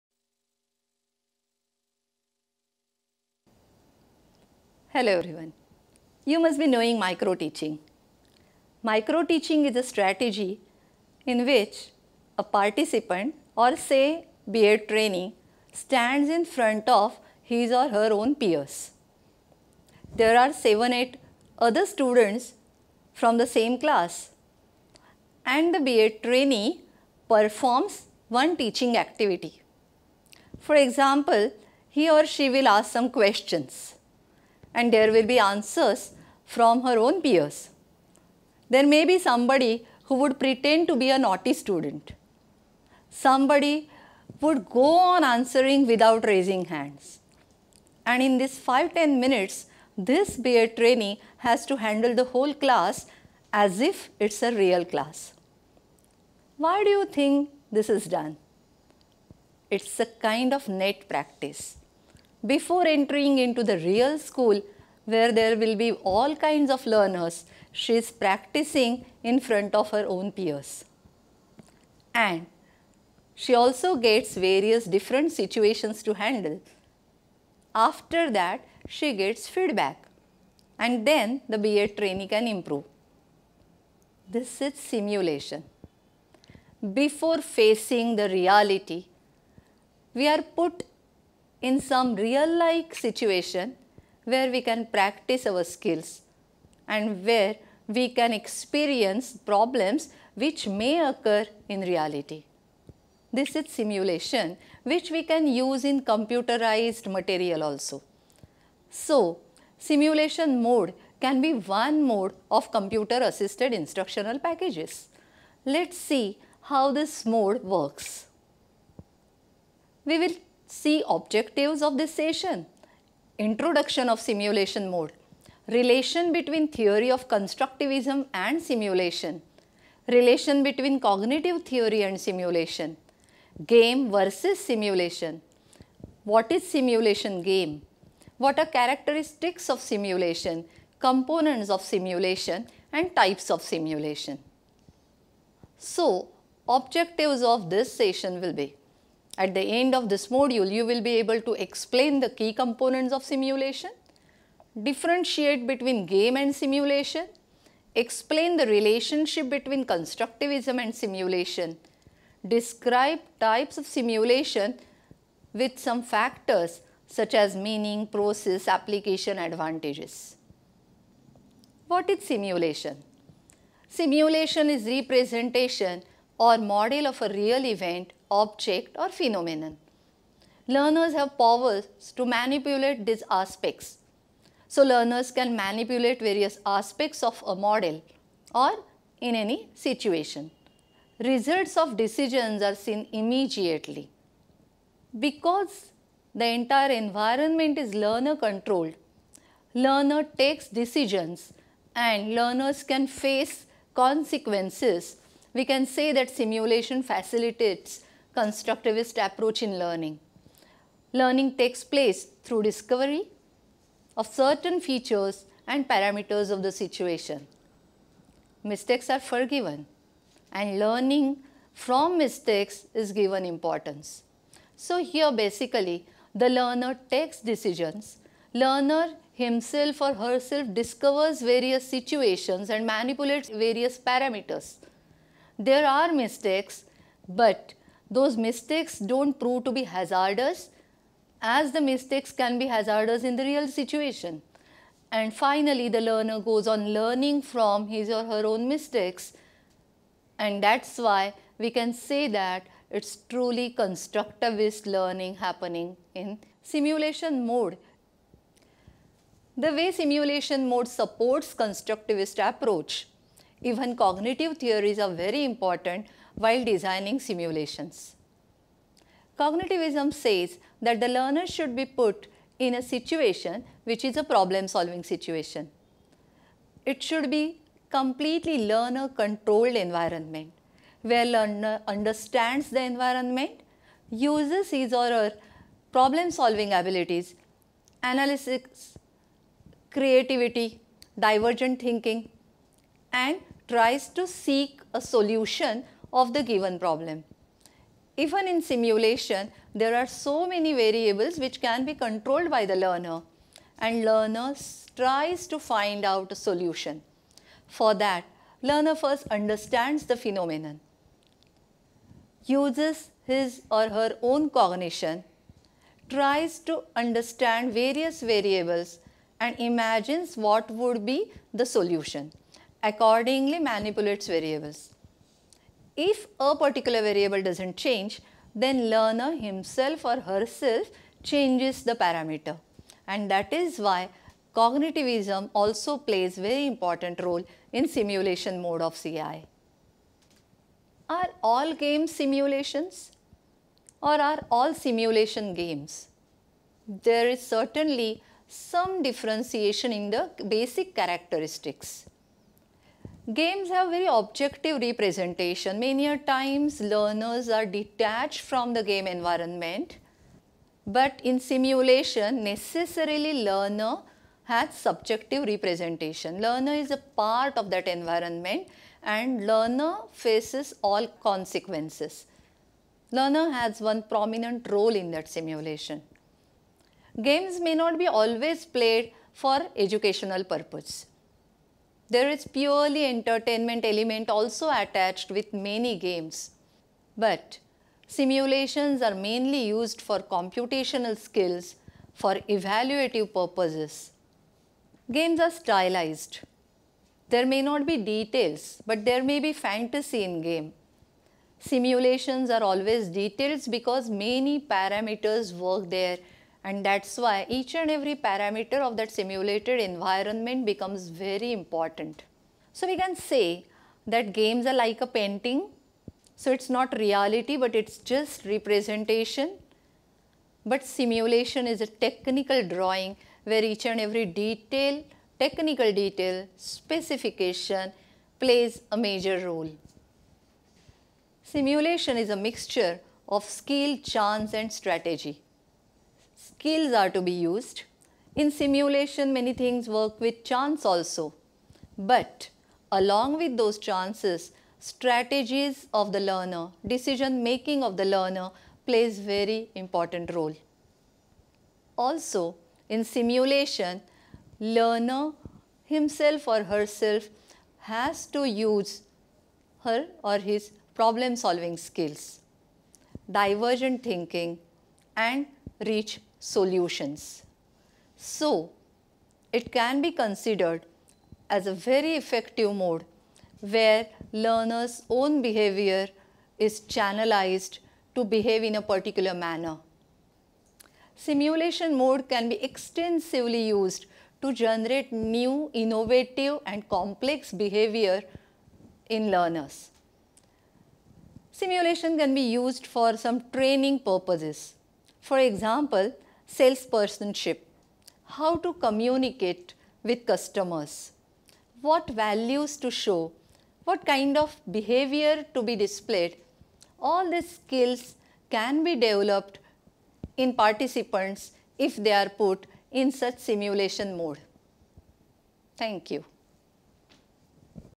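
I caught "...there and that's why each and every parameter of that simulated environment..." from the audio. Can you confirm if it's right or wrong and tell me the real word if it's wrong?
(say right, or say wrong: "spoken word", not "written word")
right.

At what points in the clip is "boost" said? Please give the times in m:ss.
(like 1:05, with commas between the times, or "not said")
not said.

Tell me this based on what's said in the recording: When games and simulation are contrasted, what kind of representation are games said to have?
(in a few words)
Objective representation.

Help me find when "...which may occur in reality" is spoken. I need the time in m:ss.
1:40.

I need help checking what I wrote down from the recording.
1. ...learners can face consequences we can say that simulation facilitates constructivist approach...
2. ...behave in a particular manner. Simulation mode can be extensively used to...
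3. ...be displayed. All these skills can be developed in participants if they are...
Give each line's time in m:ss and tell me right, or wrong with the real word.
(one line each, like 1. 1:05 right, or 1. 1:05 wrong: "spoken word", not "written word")
1. 3:22 right
2. 7:58 right
3. 8:25 right.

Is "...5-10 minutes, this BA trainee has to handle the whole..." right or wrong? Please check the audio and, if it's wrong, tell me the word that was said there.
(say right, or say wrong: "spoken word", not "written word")
right.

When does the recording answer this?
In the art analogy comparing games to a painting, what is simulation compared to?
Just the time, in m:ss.
7:01.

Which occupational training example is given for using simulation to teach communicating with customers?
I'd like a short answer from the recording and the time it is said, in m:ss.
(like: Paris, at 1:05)
Salespersonship, at 8:16.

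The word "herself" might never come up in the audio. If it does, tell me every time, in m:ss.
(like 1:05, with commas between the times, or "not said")
3:50, 5:30, 7:36.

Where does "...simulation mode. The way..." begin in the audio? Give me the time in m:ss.
4:16.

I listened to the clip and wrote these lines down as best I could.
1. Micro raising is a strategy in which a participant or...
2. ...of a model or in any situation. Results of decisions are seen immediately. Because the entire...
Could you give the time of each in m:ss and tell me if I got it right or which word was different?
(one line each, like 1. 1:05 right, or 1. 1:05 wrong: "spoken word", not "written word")
1. 0:08 wrong: "teaching", not "raising"
2. 3:07 right.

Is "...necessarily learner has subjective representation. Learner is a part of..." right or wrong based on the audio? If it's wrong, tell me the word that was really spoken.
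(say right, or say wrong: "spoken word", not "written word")
right.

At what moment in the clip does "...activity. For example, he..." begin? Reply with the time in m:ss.
0:29.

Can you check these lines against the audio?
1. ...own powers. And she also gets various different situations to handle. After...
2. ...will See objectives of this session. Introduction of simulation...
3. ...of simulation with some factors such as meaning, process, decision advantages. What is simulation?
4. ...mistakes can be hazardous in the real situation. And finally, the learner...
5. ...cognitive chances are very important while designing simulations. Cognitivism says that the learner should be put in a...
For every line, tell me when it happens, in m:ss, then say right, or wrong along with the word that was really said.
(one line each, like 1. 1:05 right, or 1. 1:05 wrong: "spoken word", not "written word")
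1. 1:10 wrong: "peers", not "powers"
2. 2:00 right
3. 2:43 wrong: "application", not "decision"
4. 4:01 right
5. 4:23 wrong: "theories", not "chances".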